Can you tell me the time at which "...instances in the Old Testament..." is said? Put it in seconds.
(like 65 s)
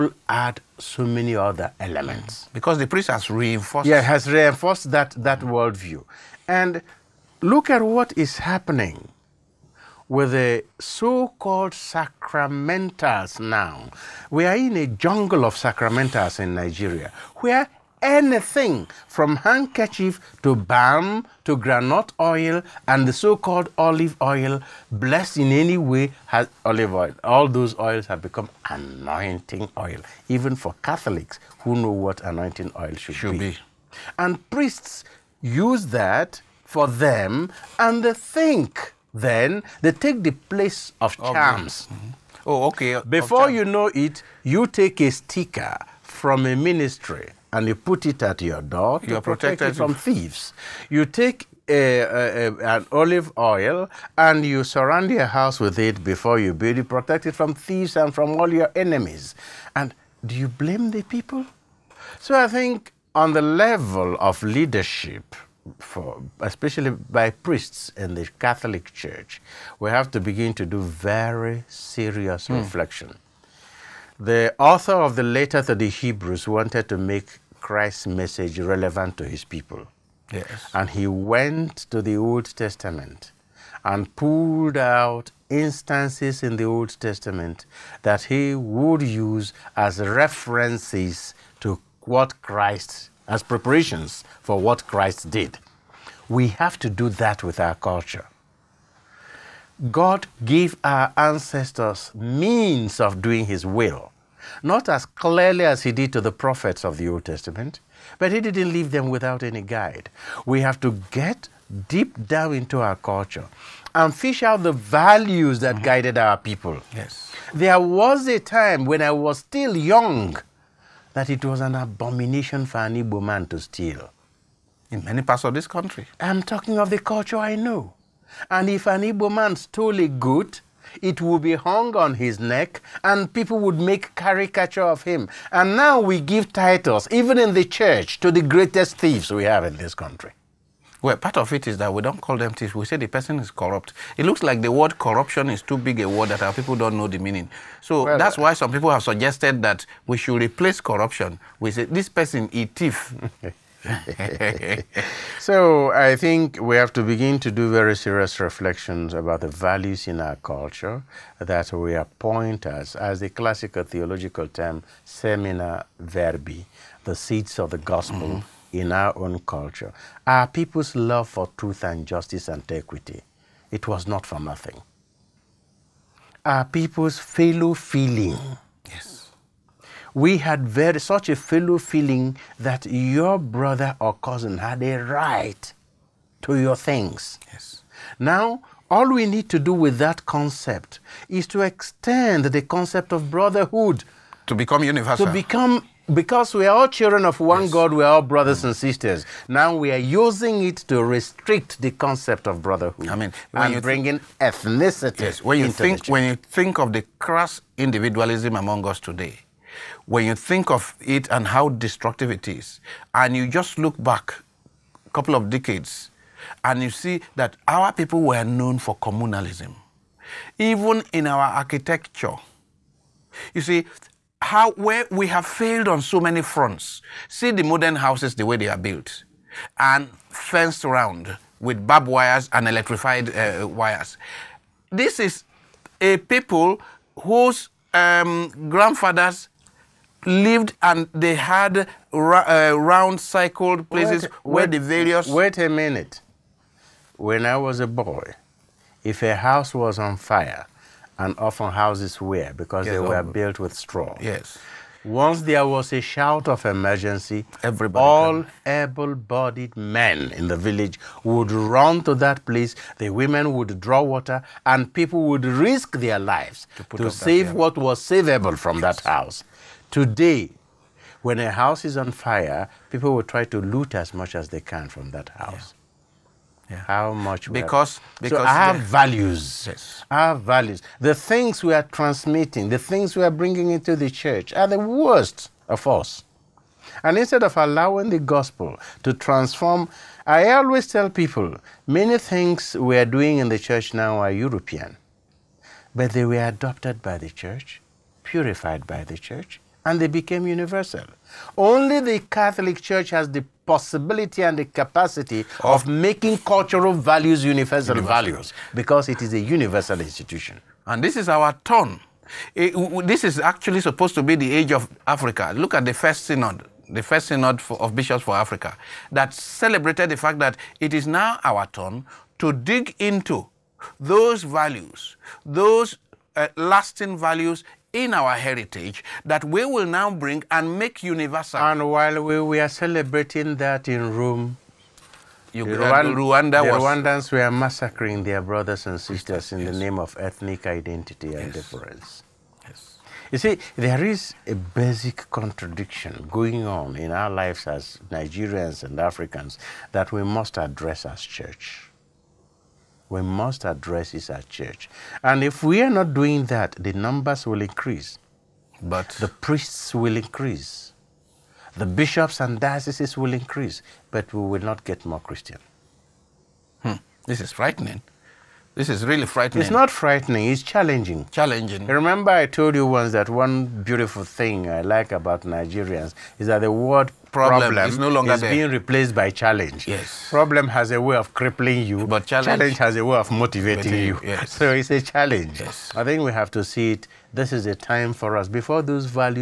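85 s.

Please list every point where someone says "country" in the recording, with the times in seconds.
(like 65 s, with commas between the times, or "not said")
125 s, 139 s.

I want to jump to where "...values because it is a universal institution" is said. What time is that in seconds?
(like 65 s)
308 s.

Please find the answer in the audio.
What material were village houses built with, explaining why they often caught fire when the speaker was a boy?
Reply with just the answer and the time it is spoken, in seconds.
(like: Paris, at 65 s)
straw, at 253 s.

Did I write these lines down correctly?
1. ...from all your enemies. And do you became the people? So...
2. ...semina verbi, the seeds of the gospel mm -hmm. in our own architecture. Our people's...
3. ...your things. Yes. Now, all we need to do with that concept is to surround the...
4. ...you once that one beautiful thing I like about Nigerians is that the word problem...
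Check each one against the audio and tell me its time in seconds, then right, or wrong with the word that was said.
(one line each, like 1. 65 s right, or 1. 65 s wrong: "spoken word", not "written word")
1. 58 s wrong: "blame", not "became"
2. 165 s wrong: "culture", not "architecture"
3. 186 s wrong: "extend", not "surround"
4. 372 s right.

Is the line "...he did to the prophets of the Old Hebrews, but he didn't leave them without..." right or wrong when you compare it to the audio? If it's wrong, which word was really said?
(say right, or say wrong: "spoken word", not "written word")
wrong: "Testament", not "Hebrews".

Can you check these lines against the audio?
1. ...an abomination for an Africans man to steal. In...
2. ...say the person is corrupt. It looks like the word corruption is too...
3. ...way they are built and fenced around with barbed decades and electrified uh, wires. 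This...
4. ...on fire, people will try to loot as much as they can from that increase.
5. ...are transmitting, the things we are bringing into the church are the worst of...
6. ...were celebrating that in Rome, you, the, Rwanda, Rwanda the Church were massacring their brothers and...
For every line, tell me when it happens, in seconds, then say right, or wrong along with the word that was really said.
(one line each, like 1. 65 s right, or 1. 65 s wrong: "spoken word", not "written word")
1. 121 s wrong: "Igbo", not "Africans"
2. 142 s right
3. 228 s wrong: "wires", not "decades"
4. 271 s wrong: "house", not "increase"
5. 281 s right
6. 332 s wrong: "Rwandans", not "Church".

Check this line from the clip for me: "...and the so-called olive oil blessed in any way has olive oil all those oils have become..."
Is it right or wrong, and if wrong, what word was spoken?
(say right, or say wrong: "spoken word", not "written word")
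right.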